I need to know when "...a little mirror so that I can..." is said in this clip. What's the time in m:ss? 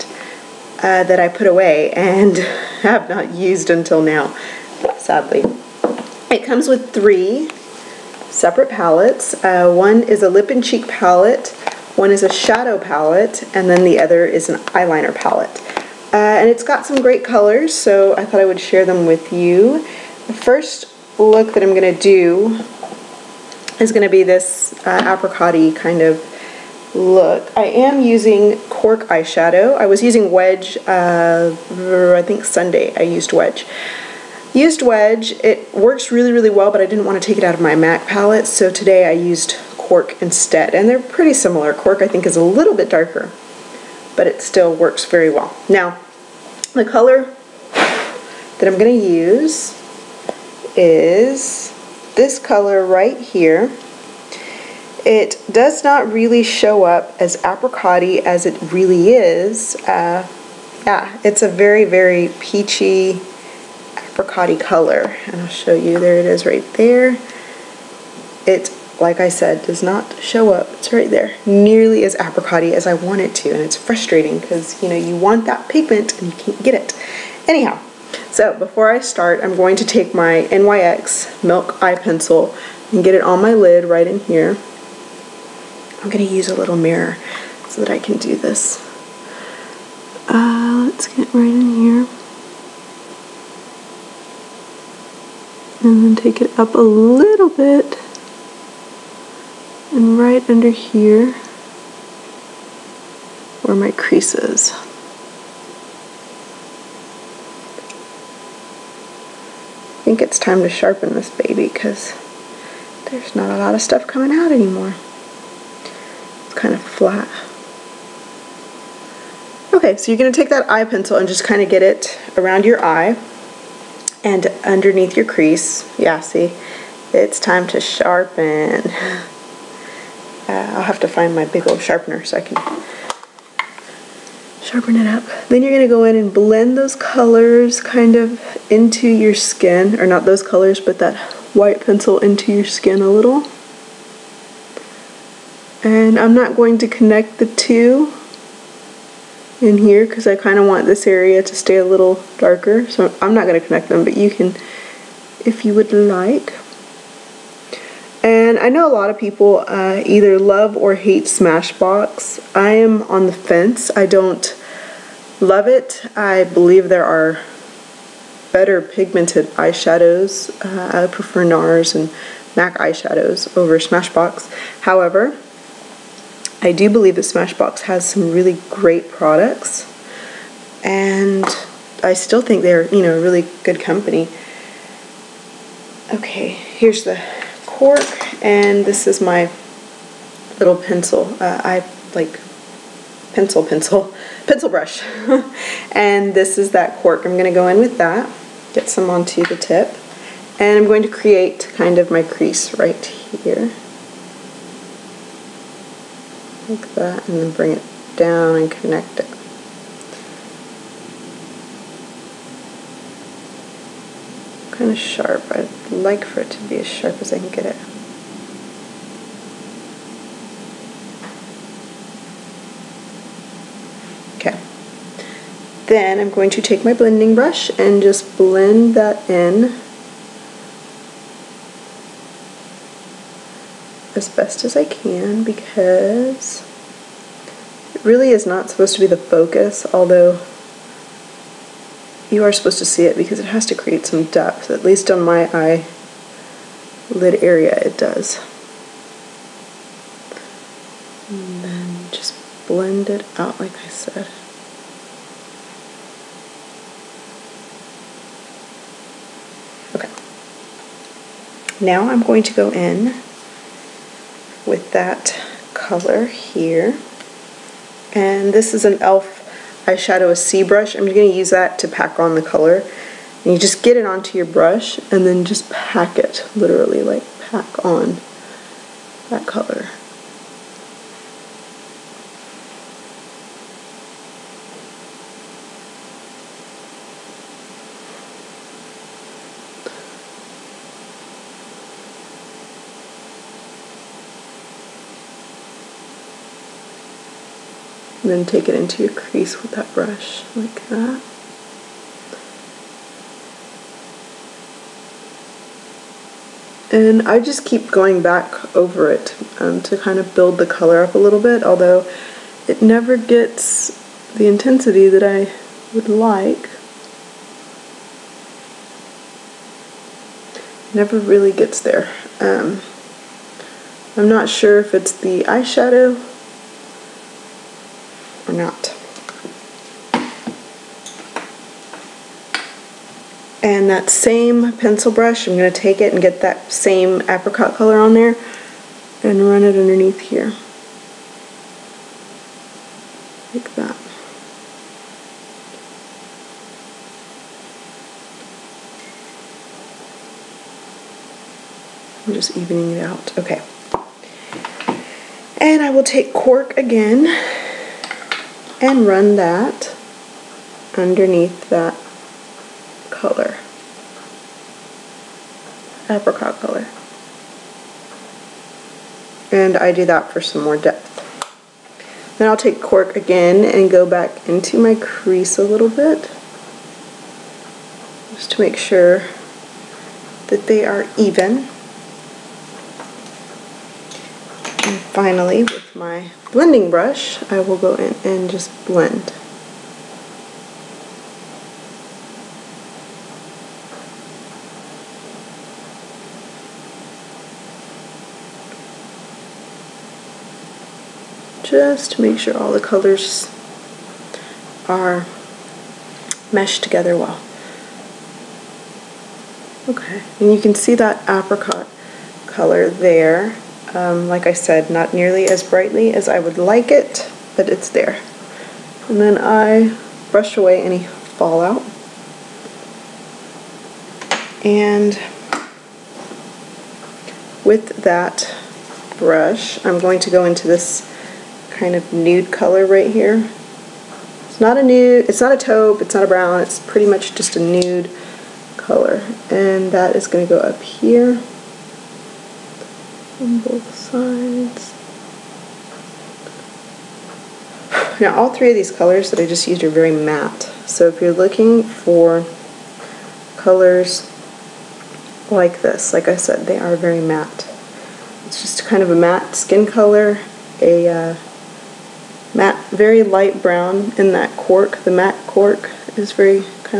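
1:26.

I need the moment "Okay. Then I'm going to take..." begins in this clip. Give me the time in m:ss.
3:44.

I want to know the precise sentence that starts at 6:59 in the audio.
And then I brush away any fallout.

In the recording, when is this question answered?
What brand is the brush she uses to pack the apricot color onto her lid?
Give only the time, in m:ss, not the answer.
4:28.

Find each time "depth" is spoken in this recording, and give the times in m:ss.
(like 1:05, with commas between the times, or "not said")
4:04, 6:10.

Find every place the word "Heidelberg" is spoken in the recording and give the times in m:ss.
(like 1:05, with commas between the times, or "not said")
not said.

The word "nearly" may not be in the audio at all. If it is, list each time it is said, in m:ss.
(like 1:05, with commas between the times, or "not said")
1:11, 6:55.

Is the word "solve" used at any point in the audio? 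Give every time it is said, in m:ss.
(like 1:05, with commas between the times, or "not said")
not said.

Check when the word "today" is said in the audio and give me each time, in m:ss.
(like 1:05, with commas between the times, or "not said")
0:38.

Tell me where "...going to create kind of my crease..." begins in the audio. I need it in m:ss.
3:20.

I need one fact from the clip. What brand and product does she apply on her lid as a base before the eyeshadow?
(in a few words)
NYX Milk Eye Pencil.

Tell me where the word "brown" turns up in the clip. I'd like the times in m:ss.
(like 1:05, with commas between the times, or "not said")
7:16, 7:43.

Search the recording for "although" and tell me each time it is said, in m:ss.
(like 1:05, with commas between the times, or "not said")
3:59, 5:11.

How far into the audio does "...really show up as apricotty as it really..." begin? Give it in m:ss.
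0:56.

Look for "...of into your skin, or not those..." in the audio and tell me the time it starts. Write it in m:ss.
2:18.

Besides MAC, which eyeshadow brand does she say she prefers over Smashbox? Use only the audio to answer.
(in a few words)
NARS.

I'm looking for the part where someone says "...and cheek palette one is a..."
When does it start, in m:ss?
0:10.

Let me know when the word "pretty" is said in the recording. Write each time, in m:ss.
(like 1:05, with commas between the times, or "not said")
0:40, 7:16.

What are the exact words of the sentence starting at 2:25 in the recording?
And I'm not going to connect the two in here because I kind of want this area to stay a little darker.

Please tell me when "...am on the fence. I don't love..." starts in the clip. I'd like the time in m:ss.
2:42.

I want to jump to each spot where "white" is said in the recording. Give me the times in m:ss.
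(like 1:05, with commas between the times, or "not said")
2:21.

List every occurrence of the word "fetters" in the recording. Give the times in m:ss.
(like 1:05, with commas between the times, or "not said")
not said.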